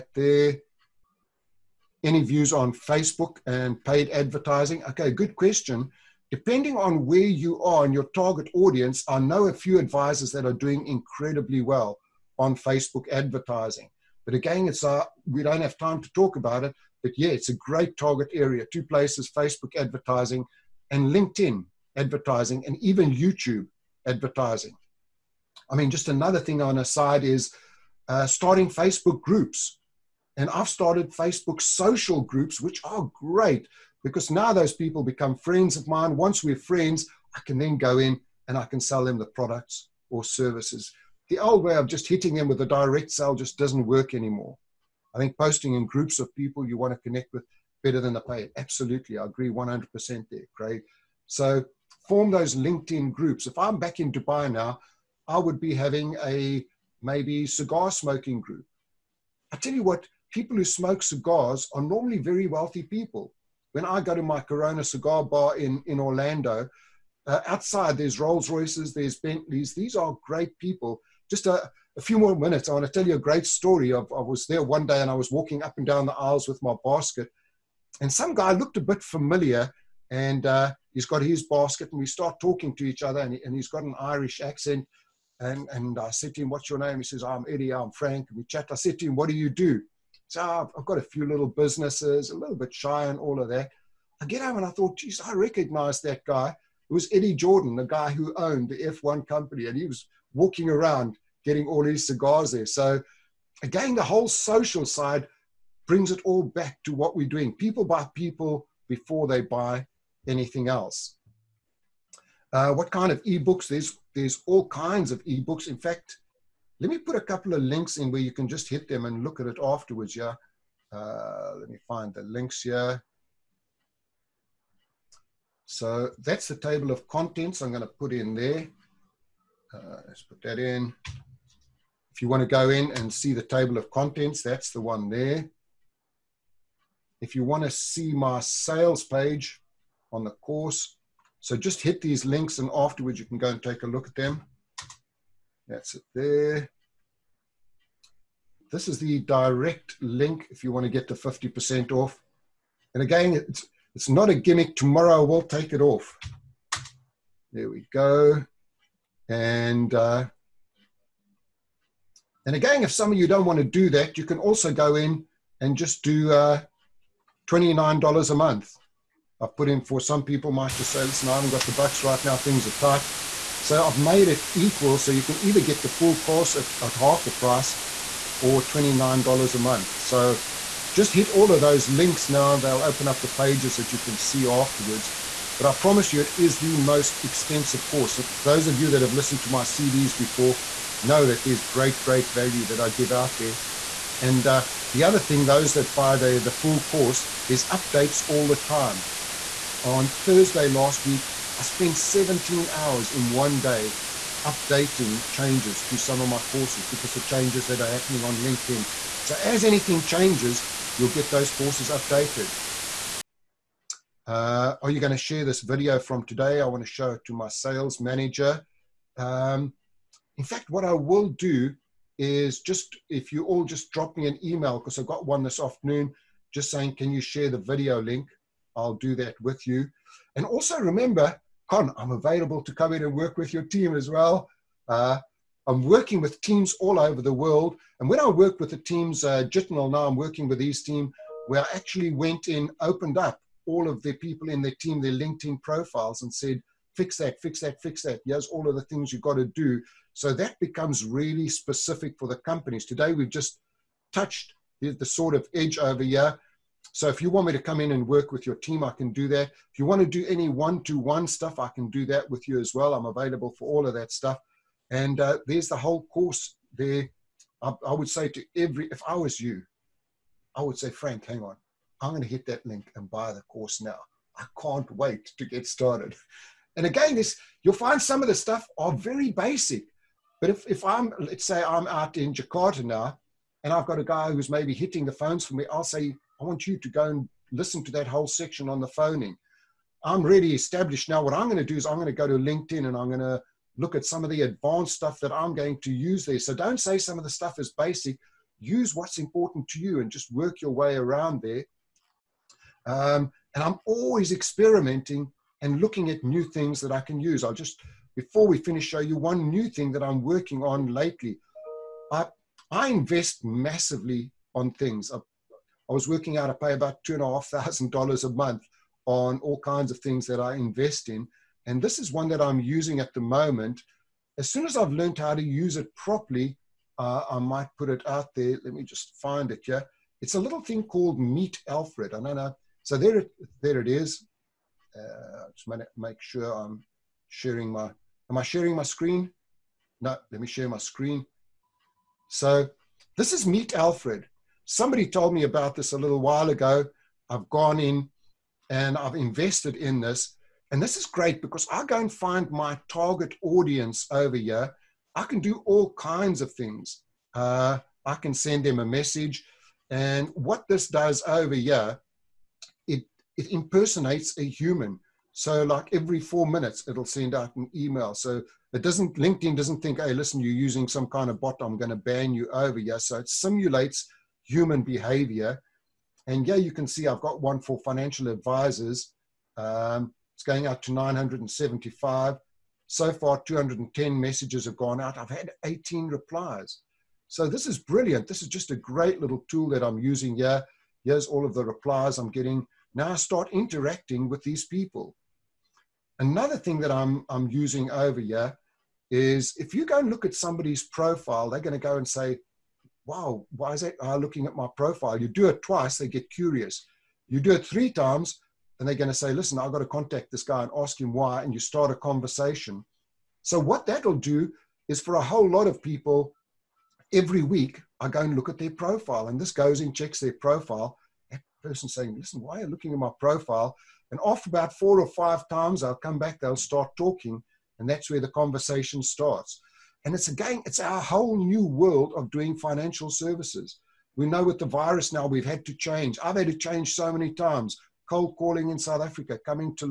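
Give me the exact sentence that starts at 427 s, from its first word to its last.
And that's where the conversation starts.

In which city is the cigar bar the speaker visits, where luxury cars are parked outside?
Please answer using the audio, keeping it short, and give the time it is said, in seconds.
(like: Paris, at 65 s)
Orlando, at 65 s.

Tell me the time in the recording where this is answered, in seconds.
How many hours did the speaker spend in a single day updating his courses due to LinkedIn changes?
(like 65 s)
201 s.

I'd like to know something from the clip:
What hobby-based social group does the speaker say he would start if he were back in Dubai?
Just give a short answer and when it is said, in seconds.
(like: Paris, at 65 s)
cigar smoking group, at 57 s.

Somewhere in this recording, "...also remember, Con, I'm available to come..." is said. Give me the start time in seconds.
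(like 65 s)
230 s.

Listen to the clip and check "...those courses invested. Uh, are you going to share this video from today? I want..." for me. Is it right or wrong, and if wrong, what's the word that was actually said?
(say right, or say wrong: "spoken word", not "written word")
wrong: "updated", not "invested".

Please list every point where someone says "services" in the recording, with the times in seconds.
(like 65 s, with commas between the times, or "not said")
40 s, 433 s.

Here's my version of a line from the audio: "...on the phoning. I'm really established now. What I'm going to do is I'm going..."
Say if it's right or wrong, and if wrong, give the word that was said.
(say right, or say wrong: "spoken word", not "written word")
right.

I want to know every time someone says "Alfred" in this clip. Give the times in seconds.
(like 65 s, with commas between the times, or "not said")
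331 s, 343 s.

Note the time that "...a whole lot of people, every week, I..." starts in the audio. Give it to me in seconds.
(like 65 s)
415 s.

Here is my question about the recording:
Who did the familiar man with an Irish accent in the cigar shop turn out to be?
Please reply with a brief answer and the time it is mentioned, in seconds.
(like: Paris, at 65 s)
Eddie Jordan, at 97 s.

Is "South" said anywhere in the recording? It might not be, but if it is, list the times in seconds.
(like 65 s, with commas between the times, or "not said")
438 s.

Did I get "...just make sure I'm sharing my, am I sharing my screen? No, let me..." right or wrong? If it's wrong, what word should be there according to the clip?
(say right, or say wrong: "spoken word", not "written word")
right.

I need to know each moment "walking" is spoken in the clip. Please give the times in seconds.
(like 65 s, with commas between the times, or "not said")
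75 s, 100 s.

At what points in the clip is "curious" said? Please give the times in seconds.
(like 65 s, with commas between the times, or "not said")
406 s.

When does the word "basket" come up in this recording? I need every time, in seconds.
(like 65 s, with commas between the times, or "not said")
76 s, 81 s.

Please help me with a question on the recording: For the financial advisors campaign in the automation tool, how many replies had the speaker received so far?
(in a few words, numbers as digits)
18.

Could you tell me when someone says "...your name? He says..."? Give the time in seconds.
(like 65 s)
86 s.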